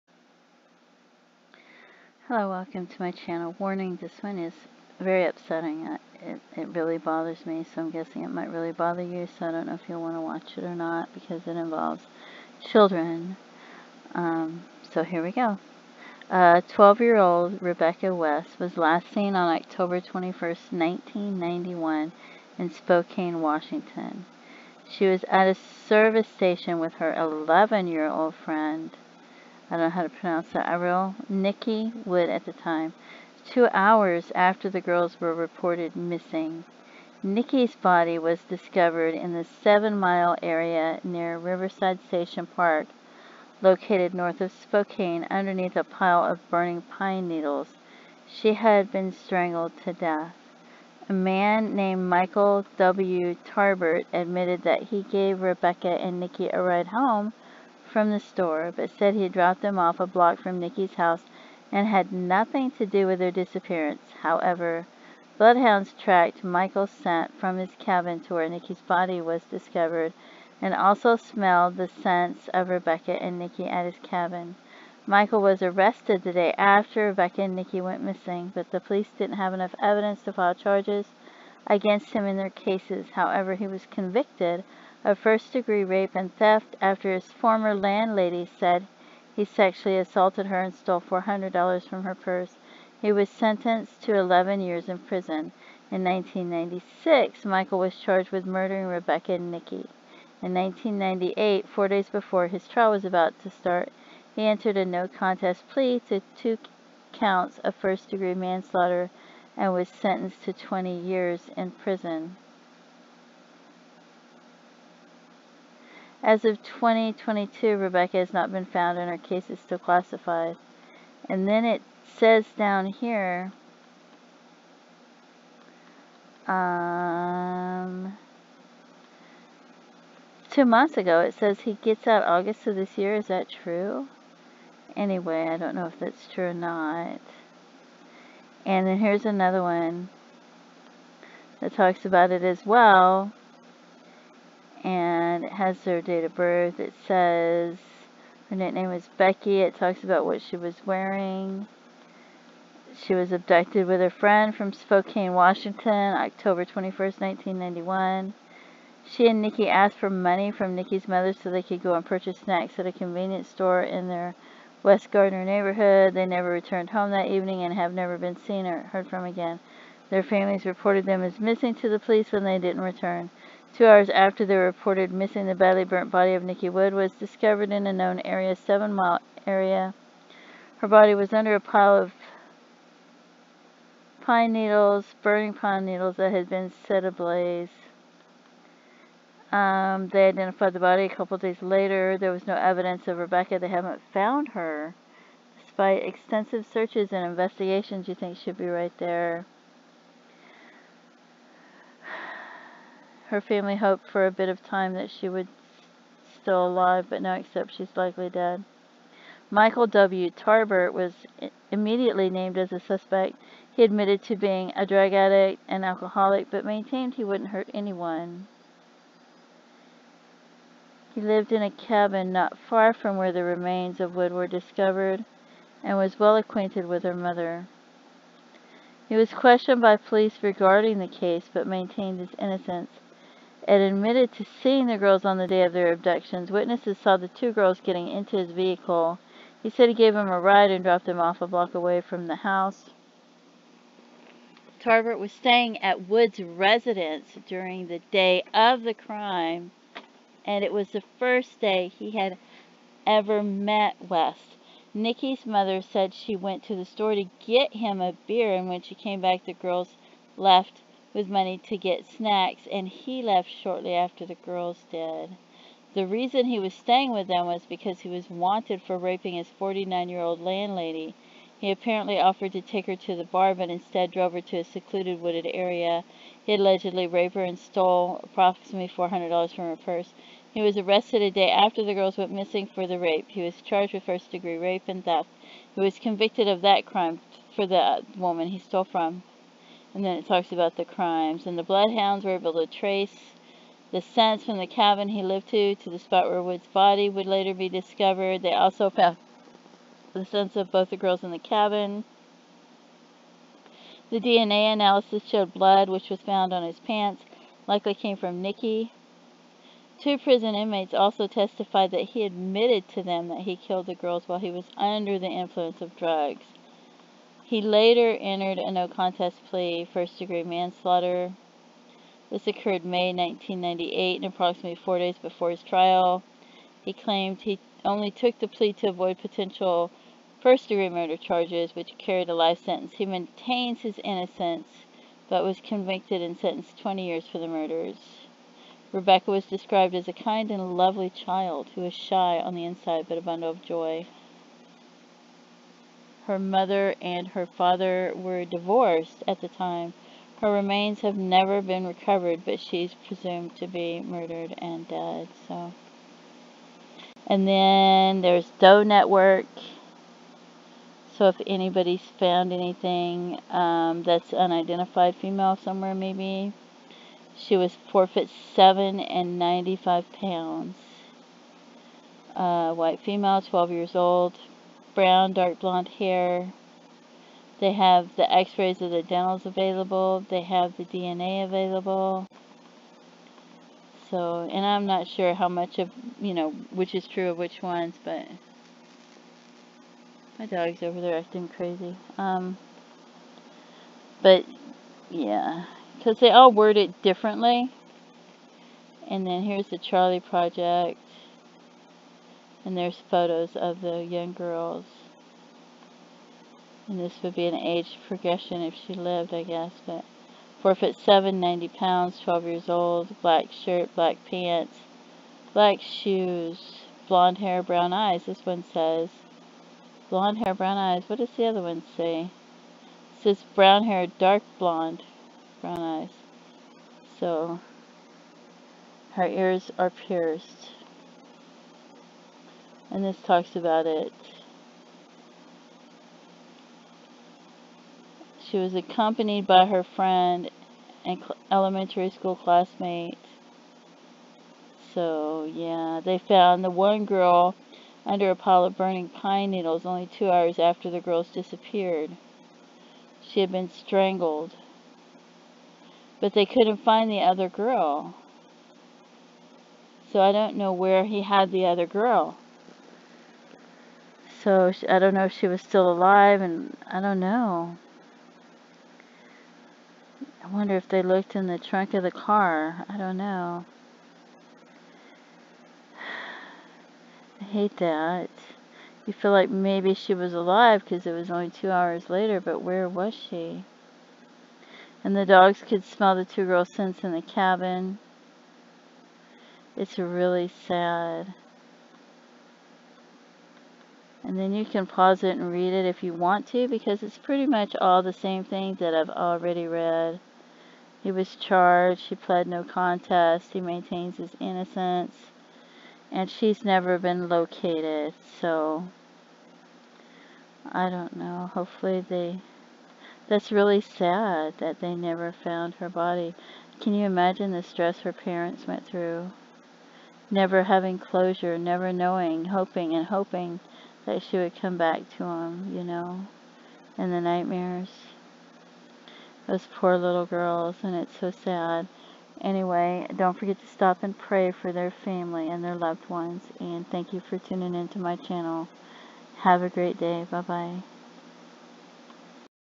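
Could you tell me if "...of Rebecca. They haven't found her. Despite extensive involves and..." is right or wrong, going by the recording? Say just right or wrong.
wrong.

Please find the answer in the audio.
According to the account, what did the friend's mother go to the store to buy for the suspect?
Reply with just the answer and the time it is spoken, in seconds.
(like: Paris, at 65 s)
beer, at 258 s.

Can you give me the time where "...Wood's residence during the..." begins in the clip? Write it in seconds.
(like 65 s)
246 s.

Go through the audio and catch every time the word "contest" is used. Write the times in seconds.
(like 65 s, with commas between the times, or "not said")
105 s, 318 s, 502 s.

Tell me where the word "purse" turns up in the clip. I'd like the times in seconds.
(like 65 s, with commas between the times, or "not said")
92 s, 279 s.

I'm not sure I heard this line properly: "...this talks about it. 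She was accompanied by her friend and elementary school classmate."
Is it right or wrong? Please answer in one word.
right.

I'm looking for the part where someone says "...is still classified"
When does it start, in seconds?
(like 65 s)
119 s.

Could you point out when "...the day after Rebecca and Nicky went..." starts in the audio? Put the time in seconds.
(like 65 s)
76 s.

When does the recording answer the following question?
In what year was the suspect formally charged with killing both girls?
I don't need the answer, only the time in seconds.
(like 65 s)
96 s.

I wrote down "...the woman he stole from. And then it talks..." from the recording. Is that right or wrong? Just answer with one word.
right.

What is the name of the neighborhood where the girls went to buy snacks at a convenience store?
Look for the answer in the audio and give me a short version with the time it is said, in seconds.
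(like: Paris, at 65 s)
West Gardner, at 164 s.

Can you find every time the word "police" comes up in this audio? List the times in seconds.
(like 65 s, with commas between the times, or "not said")
78 s, 171 s, 229 s.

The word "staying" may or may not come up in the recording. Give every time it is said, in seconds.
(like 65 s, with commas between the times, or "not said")
245 s, 266 s.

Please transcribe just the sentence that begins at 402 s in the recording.
And there's photos of the young girls.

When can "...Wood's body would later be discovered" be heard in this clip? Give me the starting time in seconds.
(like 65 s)
296 s.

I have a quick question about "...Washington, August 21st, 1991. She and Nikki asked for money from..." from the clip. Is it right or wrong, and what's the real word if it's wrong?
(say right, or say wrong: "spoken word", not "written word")
wrong: "October", not "August".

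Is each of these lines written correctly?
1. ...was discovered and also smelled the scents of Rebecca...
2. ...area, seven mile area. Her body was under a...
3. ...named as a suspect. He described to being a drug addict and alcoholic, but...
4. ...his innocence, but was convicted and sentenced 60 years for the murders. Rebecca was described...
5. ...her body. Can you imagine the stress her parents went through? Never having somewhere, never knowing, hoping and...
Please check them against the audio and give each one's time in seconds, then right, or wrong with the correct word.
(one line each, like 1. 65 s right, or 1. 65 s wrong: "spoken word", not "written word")
1. 69 s right
2. 178 s right
3. 212 s wrong: "admitted", not "described"
4. 333 s wrong: "20", not "60"
5. 515 s wrong: "closure", not "somewhere".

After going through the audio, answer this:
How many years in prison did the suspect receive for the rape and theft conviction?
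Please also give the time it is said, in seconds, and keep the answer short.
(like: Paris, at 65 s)
11 years, at 94 s.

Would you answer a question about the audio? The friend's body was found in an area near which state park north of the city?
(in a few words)
Riverside State Park.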